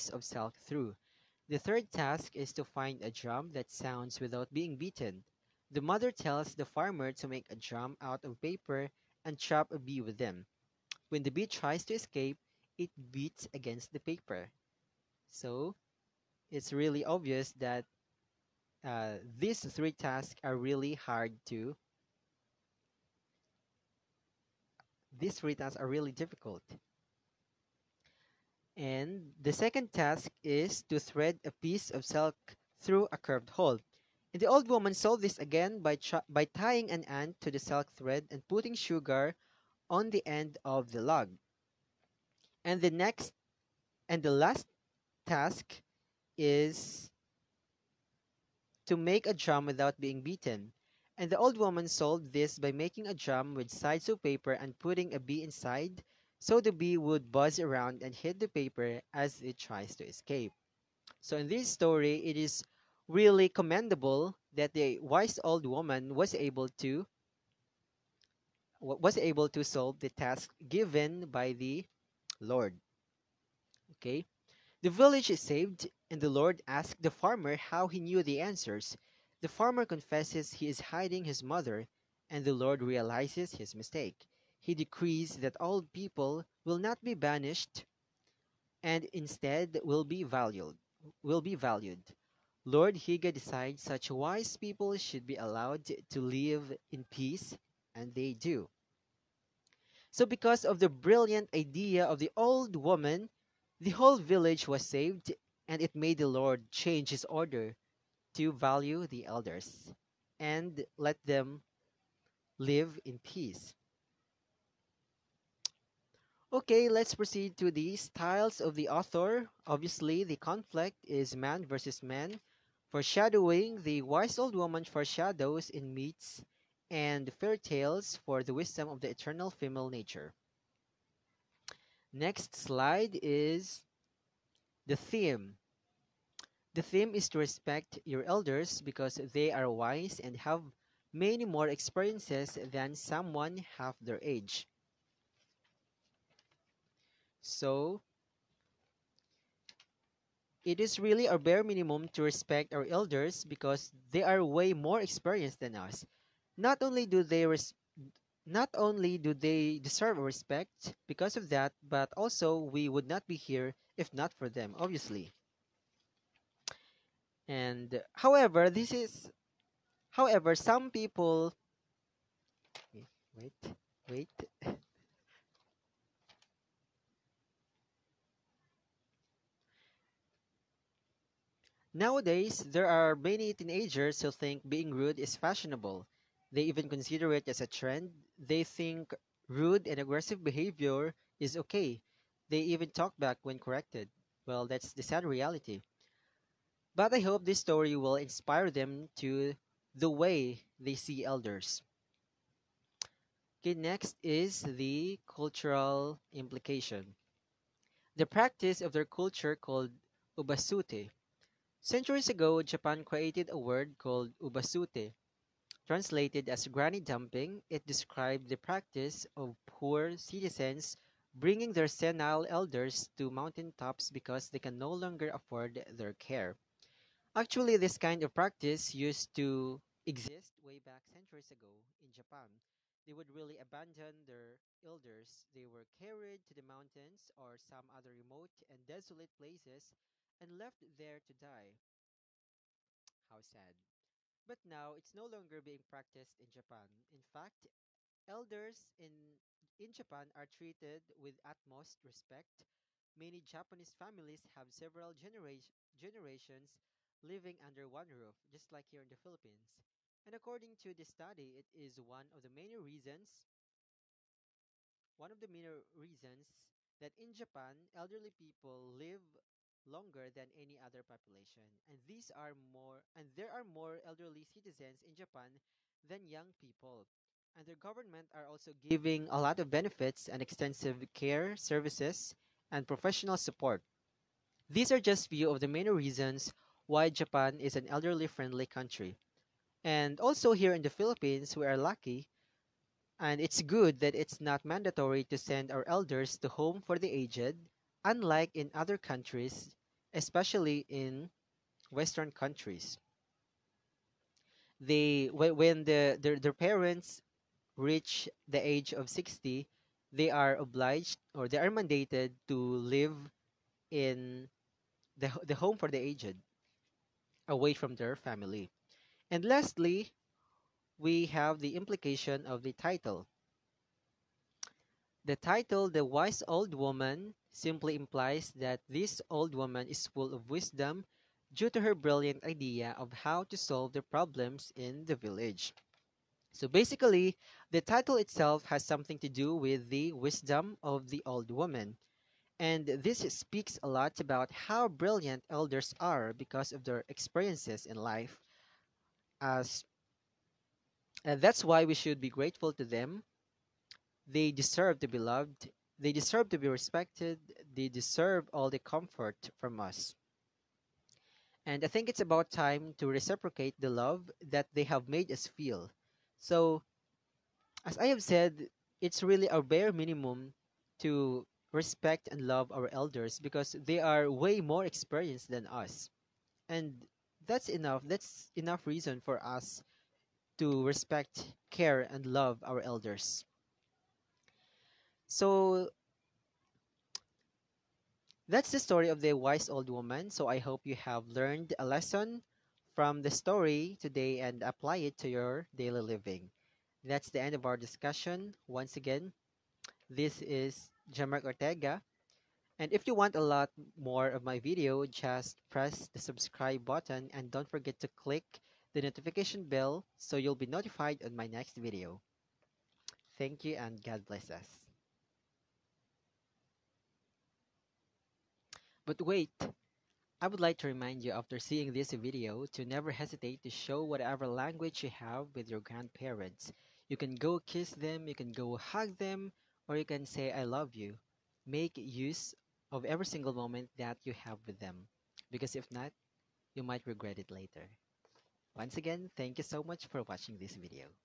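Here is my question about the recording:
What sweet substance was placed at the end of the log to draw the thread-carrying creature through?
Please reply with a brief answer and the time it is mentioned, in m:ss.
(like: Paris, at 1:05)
Sugar, at 0:38.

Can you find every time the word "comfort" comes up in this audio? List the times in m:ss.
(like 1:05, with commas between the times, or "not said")
5:58.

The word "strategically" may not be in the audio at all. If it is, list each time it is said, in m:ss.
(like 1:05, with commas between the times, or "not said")
not said.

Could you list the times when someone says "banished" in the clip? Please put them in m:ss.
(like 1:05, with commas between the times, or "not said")
1:27.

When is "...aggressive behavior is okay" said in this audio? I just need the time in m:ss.
3:09.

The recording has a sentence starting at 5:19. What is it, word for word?
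And lastly, we have the implication of the title.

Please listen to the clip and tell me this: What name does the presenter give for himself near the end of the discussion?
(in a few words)
Jemark Ortega.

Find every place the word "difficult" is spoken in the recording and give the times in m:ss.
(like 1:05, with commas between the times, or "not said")
0:26.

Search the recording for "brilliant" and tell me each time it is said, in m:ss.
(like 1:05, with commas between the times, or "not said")
1:40, 5:31, 5:44.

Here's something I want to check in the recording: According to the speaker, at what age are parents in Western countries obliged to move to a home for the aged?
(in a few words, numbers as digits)
60.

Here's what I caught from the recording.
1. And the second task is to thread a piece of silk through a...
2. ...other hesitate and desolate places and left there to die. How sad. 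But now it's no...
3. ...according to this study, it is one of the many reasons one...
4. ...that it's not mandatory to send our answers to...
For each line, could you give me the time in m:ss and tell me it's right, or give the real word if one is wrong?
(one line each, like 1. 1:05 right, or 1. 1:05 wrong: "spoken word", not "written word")
1. 0:28 right
2. 3:57 wrong: "remote", not "hesitate"
3. 4:20 right
4. 4:53 wrong: "elders", not "answers".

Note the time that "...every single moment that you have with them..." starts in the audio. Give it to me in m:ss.
7:13.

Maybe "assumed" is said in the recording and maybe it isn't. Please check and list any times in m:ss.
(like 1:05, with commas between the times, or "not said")
not said.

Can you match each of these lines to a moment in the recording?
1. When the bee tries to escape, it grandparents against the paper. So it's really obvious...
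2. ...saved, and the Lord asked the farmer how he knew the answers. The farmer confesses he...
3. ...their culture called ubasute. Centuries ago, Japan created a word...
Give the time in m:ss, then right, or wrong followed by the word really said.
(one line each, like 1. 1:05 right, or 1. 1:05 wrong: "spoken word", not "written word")
1. 0:11 wrong: "beats", not "grandparents"
2. 1:15 right
3. 3:28 right.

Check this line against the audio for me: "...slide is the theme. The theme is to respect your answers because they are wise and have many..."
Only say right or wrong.
wrong.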